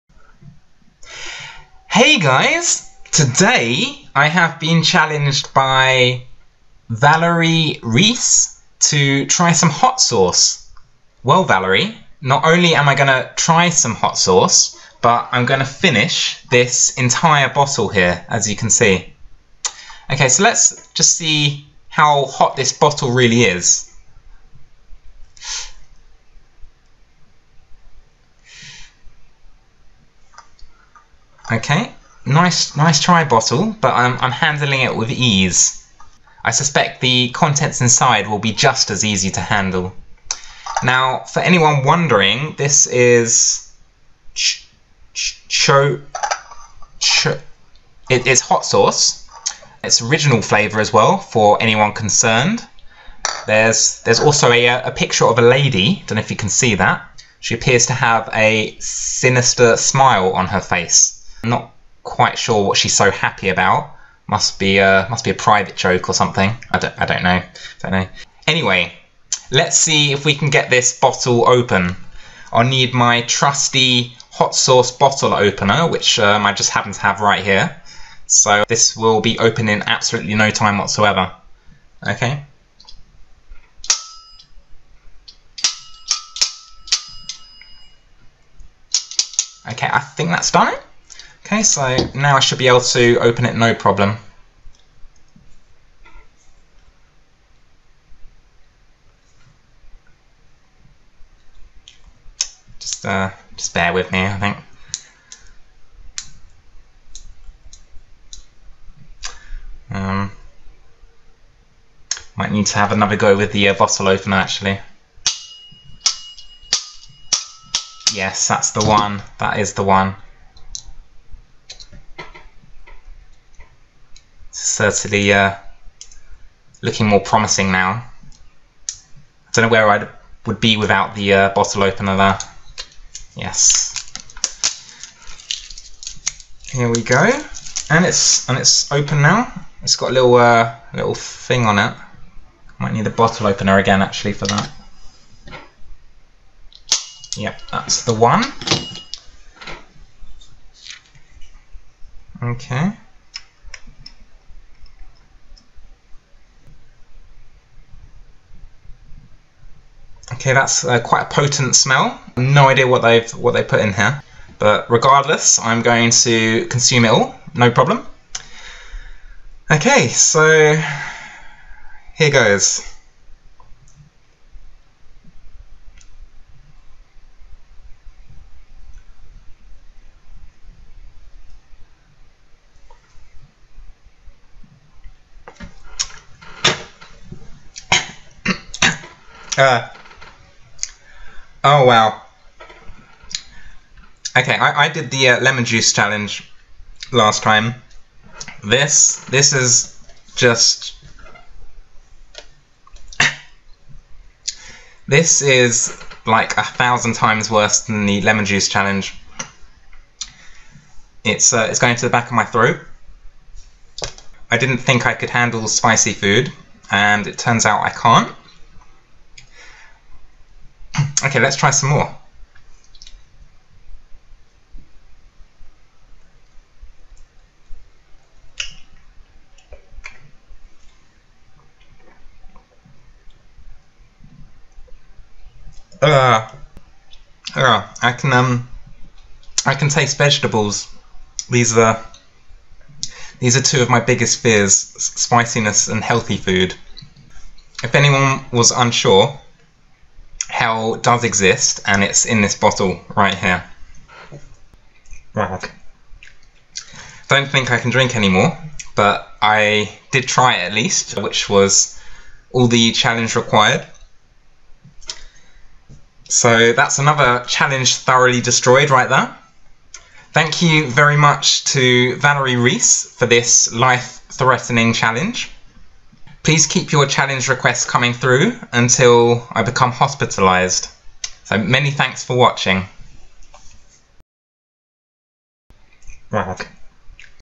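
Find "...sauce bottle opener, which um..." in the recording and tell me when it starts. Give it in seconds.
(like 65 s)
74 s.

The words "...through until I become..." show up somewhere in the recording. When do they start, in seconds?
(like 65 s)
278 s.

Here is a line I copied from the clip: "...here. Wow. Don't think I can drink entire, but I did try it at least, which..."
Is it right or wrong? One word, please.
wrong.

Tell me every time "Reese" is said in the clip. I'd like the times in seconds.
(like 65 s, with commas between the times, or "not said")
7 s, 272 s.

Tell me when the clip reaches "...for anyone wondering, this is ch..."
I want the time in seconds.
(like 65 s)
41 s.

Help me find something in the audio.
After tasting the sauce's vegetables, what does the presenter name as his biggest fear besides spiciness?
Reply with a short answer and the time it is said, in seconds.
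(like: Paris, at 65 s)
Healthy food, at 246 s.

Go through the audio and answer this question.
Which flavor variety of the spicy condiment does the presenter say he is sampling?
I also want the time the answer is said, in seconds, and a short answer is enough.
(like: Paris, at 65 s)
Original, at 50 s.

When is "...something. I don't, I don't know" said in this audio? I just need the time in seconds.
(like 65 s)
66 s.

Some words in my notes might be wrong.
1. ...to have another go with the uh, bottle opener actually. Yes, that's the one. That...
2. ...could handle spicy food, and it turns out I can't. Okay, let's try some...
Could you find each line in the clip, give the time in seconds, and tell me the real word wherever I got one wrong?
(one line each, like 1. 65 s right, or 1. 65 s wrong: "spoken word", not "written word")
1. 112 s right
2. 215 s right.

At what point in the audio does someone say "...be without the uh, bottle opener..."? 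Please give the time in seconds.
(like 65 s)
130 s.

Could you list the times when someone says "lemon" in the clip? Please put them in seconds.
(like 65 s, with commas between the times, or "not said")
195 s, 208 s.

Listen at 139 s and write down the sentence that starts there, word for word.
It's got a little uh, little thing on it.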